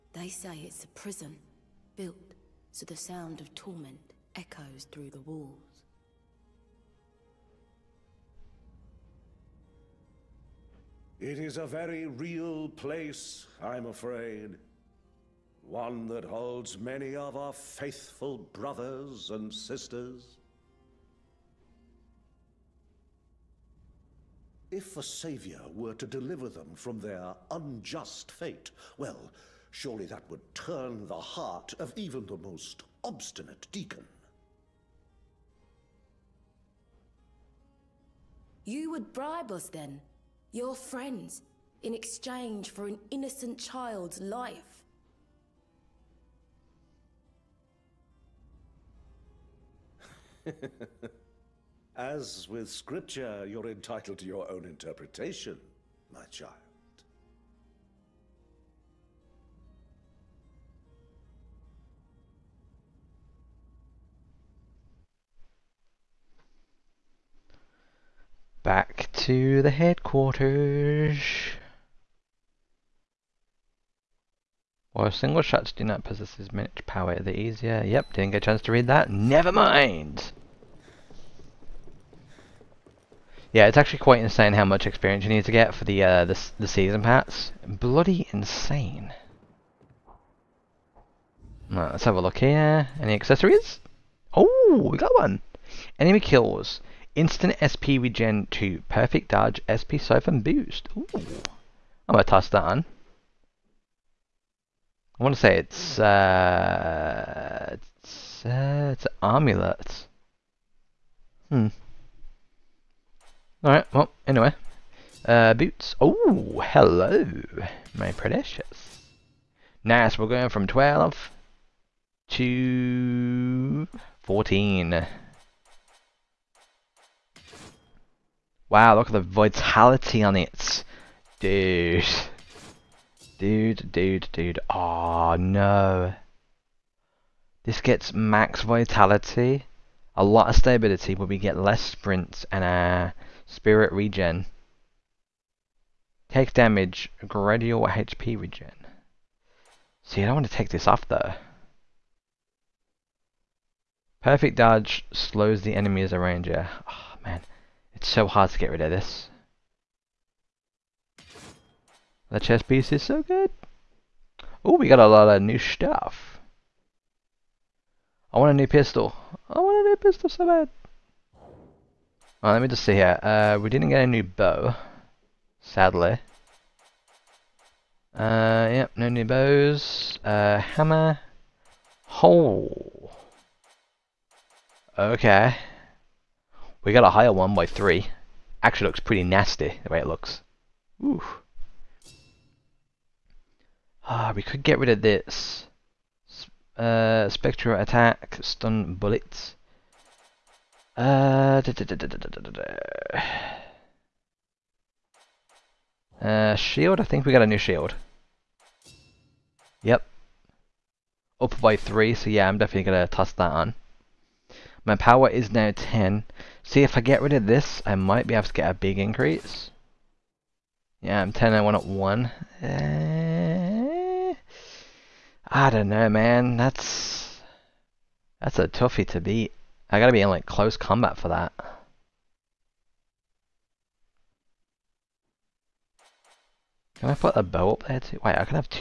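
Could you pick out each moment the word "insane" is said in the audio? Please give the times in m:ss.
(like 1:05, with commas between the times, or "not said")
1:24, 1:28.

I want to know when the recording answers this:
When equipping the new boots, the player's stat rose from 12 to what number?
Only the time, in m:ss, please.
2:04.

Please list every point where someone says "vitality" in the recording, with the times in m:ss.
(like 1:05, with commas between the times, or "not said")
2:09, 2:18.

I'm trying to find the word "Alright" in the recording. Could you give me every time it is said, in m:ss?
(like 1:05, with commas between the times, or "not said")
1:53, 2:52.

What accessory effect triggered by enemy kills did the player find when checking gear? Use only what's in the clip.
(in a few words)
Instant SP Regen 2.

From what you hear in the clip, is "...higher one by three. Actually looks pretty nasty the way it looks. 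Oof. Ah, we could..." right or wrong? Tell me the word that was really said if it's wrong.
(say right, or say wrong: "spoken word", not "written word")
right.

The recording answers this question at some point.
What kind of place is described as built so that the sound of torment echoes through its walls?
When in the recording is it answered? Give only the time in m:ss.
0:00.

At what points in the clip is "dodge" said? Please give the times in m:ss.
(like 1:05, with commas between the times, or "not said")
1:39, 2:34.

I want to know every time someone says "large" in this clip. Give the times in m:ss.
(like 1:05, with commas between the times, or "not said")
not said.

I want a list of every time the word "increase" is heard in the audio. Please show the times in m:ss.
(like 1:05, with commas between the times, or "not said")
3:38.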